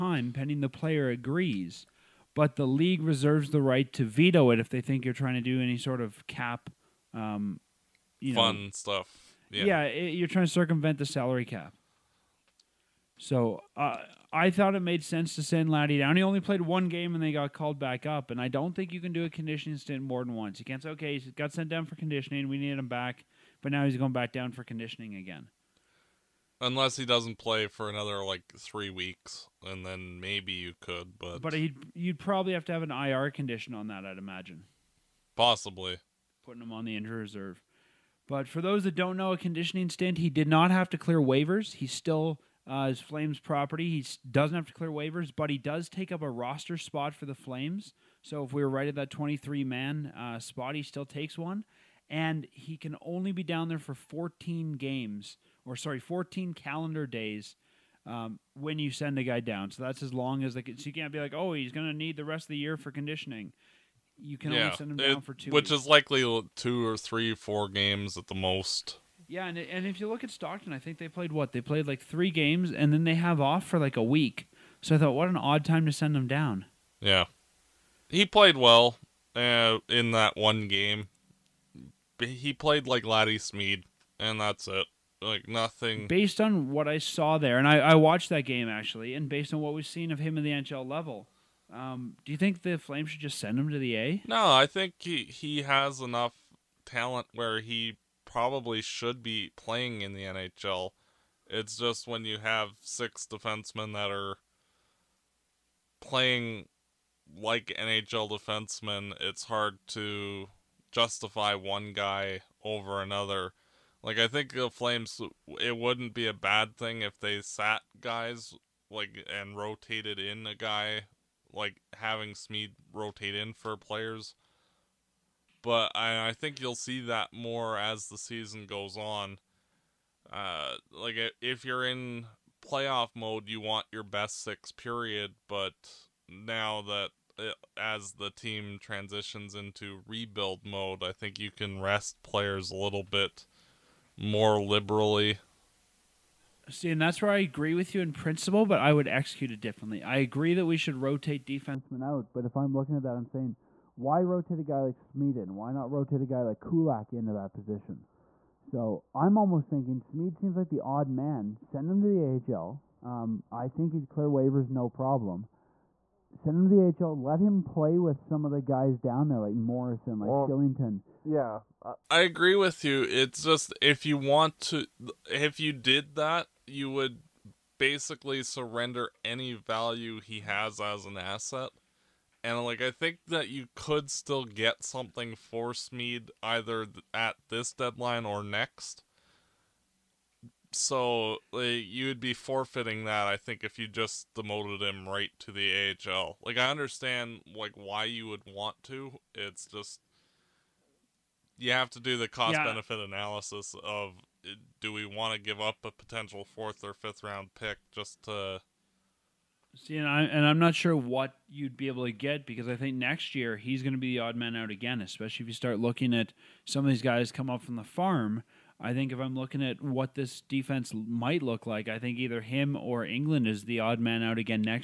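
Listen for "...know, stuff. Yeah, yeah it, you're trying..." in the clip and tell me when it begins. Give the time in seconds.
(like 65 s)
8 s.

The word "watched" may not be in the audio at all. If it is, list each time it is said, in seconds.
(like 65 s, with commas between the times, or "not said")
87 s.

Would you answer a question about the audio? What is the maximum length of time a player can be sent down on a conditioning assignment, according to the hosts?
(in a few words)
14 calendar days.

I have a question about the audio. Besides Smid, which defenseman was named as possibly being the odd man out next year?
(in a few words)
Engelland.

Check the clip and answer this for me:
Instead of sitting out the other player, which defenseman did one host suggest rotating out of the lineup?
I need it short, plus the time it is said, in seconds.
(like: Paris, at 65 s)
Kulak, at 156 s.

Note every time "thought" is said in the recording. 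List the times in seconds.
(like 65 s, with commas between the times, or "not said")
14 s, 74 s.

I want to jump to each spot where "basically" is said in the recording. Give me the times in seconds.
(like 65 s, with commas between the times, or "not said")
177 s.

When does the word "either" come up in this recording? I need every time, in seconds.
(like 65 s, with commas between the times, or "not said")
186 s, 222 s.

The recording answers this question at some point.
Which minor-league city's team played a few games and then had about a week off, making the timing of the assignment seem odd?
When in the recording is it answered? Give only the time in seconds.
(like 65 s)
70 s.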